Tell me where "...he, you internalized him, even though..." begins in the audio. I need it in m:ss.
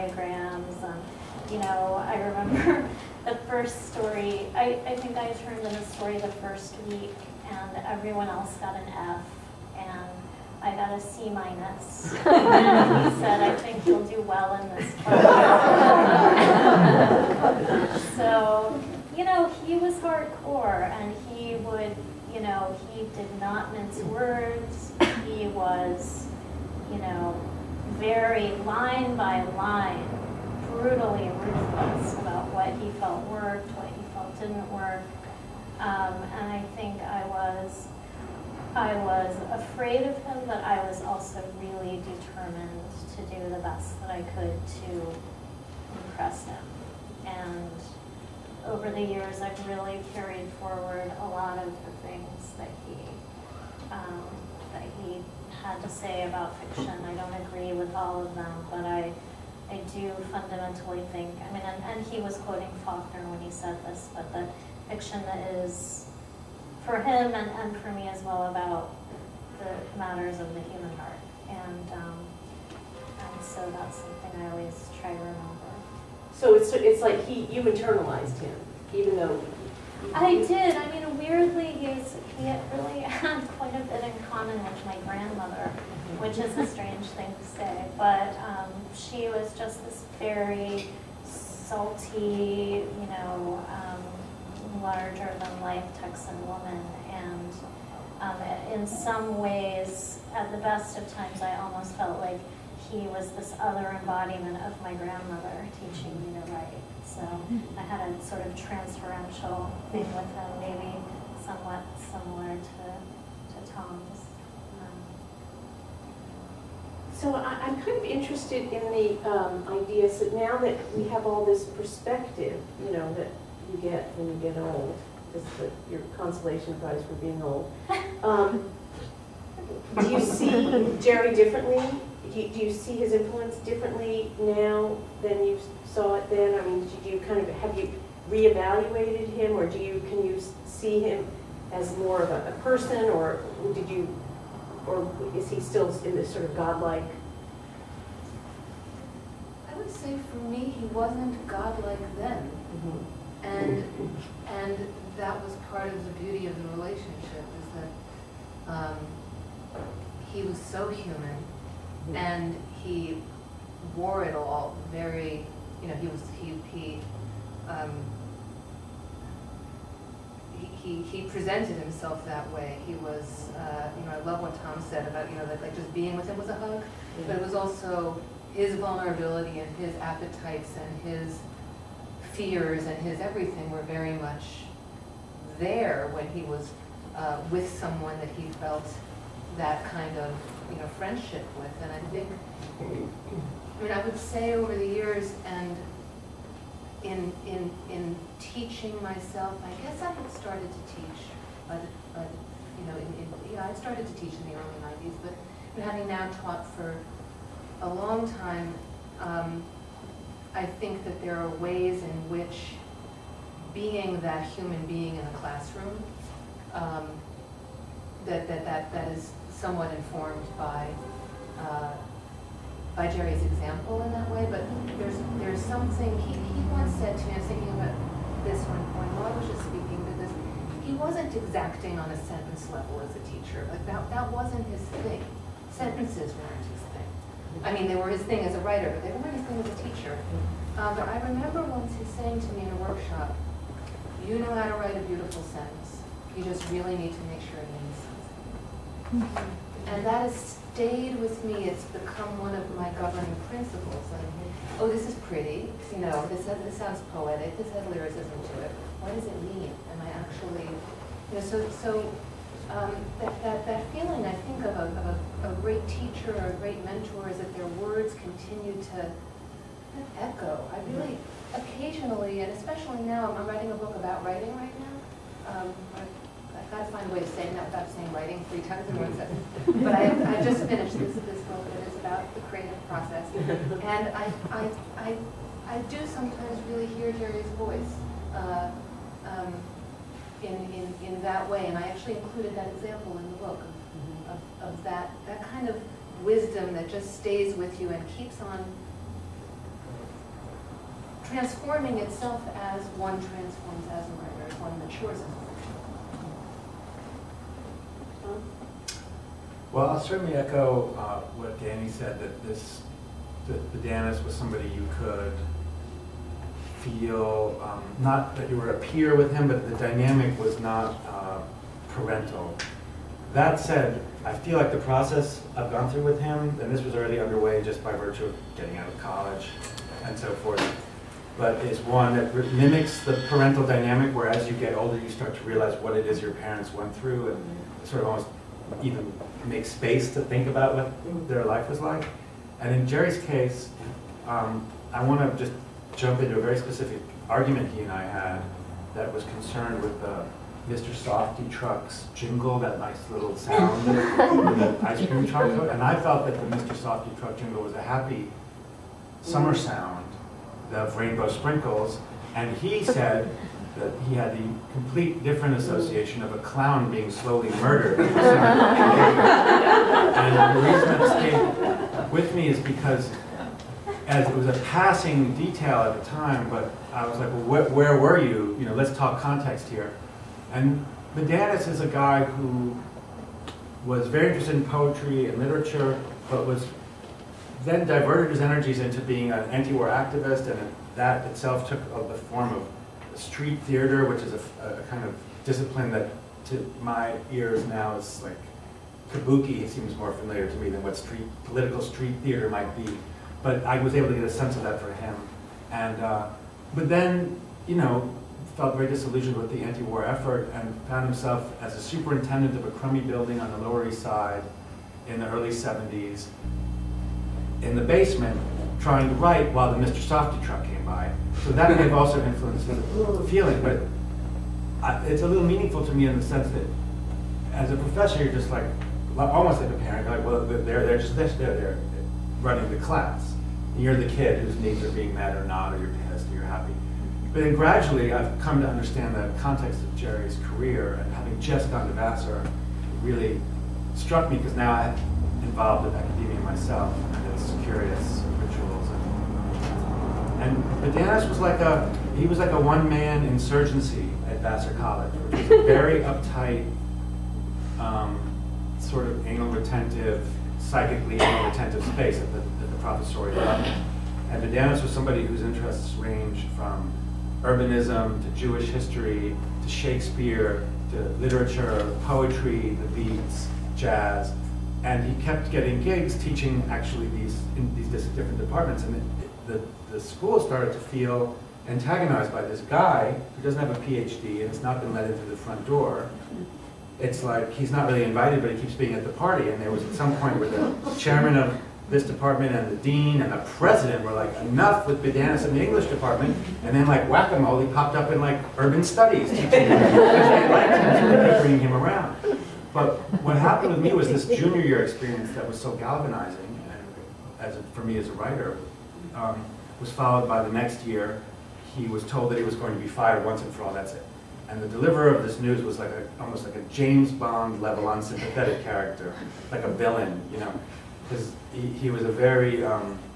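1:17.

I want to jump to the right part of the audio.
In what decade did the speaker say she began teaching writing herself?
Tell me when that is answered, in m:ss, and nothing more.
3:24.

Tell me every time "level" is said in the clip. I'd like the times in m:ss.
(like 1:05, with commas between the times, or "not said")
3:52, 7:43, 8:37.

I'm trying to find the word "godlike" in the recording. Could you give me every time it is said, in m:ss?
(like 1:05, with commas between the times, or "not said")
2:26, 2:31.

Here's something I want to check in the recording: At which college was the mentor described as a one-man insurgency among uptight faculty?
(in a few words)
Vassar College.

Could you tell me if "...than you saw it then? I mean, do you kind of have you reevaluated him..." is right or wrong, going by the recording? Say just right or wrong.
right.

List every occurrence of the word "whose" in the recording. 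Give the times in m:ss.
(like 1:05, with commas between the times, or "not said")
7:14, 7:45.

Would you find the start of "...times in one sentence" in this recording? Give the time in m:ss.
4:38.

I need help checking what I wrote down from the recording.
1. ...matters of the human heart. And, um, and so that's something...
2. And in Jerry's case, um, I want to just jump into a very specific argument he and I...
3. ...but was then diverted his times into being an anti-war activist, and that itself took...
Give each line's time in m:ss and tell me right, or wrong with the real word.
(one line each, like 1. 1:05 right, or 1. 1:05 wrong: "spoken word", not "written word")
1. 1:09 right
2. 5:42 right
3. 6:26 wrong: "energies", not "times".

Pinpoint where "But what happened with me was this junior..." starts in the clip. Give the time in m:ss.
8:22.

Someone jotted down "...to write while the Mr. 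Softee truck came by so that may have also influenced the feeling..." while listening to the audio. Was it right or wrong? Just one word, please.
right.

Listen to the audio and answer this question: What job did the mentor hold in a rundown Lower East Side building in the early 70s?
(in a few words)
superintendent.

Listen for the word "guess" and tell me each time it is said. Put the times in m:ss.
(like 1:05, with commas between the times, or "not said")
3:19.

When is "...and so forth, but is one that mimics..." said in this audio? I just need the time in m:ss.
5:30.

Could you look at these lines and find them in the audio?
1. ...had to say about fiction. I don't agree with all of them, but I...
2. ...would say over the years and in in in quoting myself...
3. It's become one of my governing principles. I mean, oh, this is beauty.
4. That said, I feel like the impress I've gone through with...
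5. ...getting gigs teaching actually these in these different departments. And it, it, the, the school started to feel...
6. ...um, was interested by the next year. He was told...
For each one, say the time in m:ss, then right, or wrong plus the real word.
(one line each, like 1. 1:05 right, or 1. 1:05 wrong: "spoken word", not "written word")
1. 0:55 right
2. 3:14 wrong: "teaching", not "quoting"
3. 4:11 wrong: "pretty", not "beauty"
4. 5:23 wrong: "process", not "impress"
5. 7:55 right
6. 8:29 wrong: "followed", not "interested".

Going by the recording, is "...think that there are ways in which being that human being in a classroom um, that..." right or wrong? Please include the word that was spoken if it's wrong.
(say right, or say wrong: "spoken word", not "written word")
right.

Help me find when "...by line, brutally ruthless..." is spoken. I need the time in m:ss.
0:29.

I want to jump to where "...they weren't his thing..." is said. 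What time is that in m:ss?
3:59.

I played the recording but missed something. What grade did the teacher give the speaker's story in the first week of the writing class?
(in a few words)
C minus.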